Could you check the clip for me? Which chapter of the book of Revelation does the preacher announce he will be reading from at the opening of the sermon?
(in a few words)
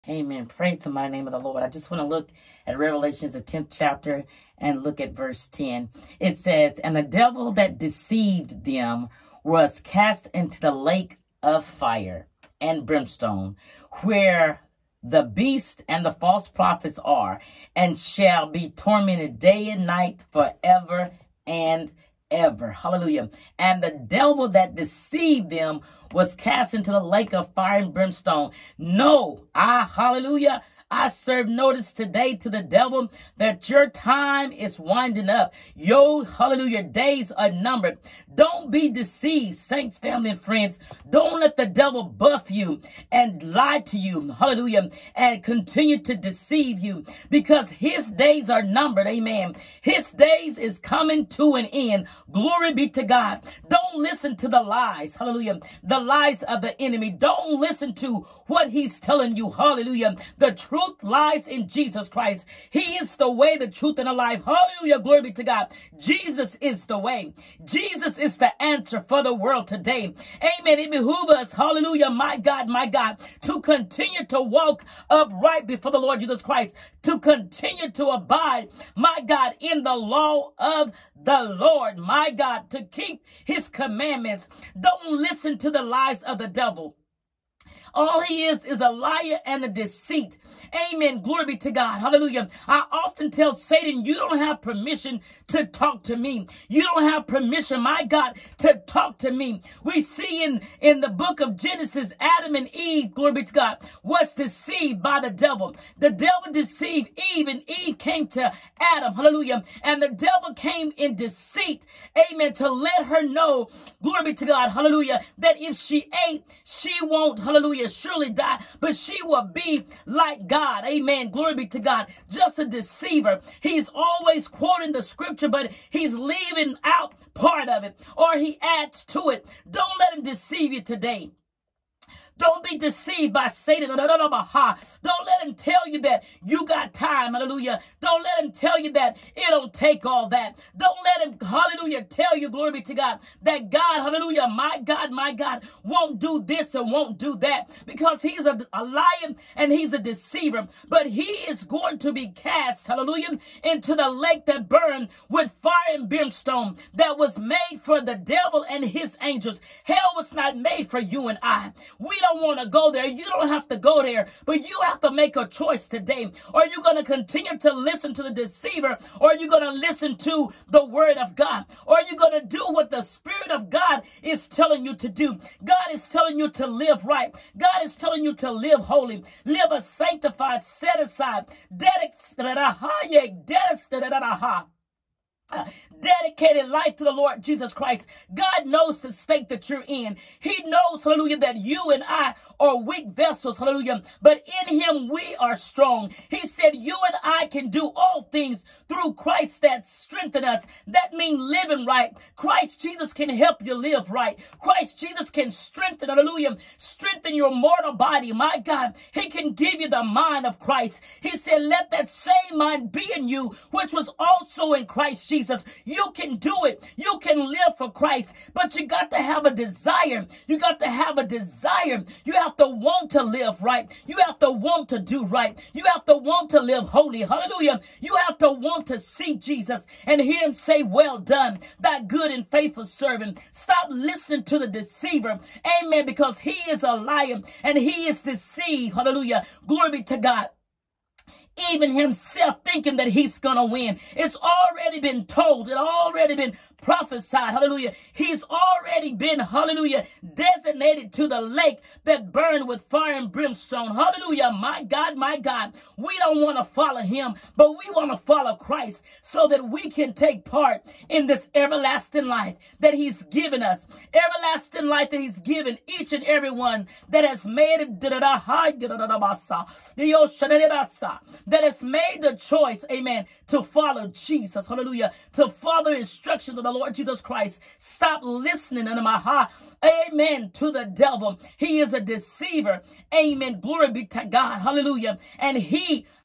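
10th chapter.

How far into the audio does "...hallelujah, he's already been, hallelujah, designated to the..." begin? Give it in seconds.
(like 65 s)
247 s.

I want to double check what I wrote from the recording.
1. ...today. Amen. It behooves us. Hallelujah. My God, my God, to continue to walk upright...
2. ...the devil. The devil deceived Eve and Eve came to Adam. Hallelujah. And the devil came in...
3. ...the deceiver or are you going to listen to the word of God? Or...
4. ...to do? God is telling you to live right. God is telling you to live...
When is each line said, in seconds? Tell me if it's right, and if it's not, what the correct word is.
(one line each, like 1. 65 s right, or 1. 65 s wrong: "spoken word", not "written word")
1. 69 s right
2. 105 s right
3. 168 s right
4. 174 s right.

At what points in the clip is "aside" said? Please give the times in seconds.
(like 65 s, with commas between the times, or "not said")
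181 s.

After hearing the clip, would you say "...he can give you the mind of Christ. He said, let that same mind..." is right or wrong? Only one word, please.
right.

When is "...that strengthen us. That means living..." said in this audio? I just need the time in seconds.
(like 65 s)
199 s.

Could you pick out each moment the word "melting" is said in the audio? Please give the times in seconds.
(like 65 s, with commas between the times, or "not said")
not said.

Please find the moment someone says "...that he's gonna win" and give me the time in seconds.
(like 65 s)
242 s.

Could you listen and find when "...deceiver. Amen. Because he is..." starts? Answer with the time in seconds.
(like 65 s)
234 s.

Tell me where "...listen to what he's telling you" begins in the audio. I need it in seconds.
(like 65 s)
57 s.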